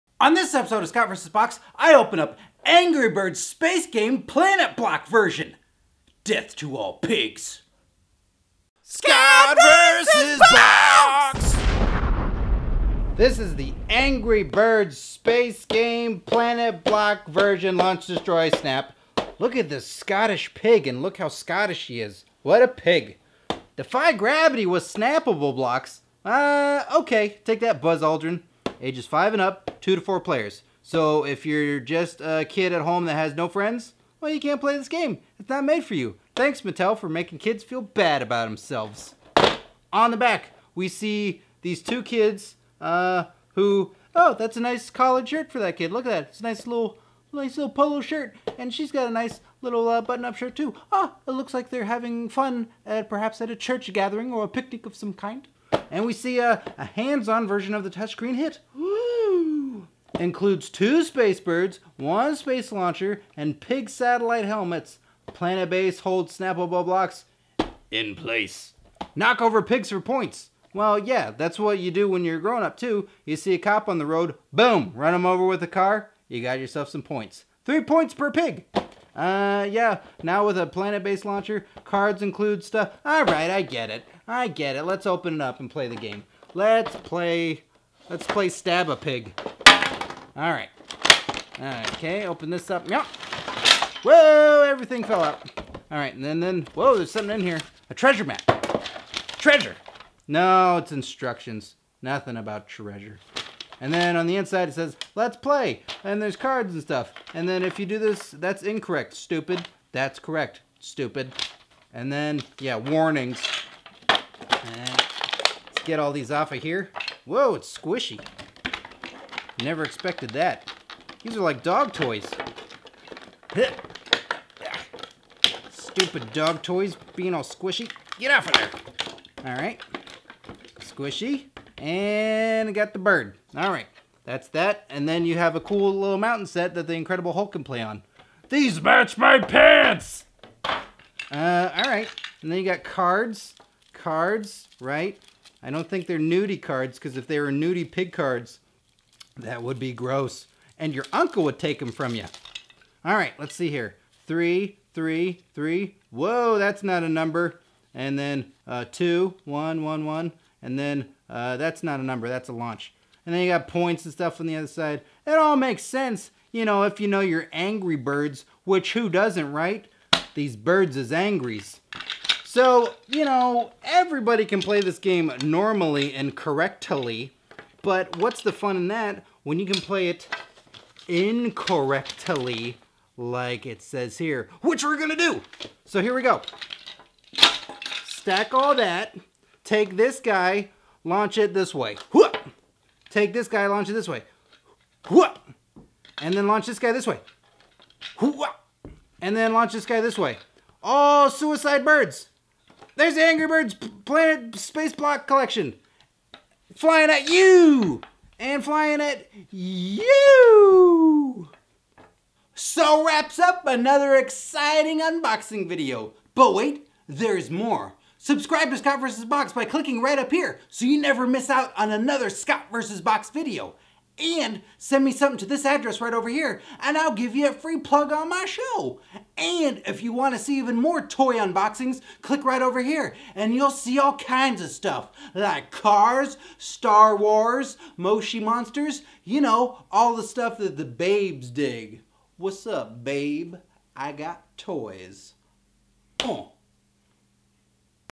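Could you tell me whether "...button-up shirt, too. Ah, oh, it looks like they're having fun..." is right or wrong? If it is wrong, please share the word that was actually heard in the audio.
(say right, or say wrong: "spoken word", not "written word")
right.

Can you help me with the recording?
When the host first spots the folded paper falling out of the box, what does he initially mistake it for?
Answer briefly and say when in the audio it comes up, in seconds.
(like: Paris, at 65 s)
A treasure map, at 97 s.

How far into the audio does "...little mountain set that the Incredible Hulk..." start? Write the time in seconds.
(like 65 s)
135 s.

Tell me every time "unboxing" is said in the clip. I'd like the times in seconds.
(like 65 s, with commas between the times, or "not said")
215 s, 231 s.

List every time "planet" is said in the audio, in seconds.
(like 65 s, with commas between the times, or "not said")
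4 s, 16 s, 65 s, 80 s, 204 s.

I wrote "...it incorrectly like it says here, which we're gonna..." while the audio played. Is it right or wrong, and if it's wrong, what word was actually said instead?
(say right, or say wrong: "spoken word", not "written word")
right.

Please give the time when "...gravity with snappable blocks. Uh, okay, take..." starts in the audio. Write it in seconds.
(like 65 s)
24 s.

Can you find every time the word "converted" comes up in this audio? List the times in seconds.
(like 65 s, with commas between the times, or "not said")
not said.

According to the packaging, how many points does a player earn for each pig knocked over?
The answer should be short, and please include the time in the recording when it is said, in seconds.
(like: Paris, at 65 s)
3 points, at 77 s.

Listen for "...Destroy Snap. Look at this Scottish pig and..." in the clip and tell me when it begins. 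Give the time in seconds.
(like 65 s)
18 s.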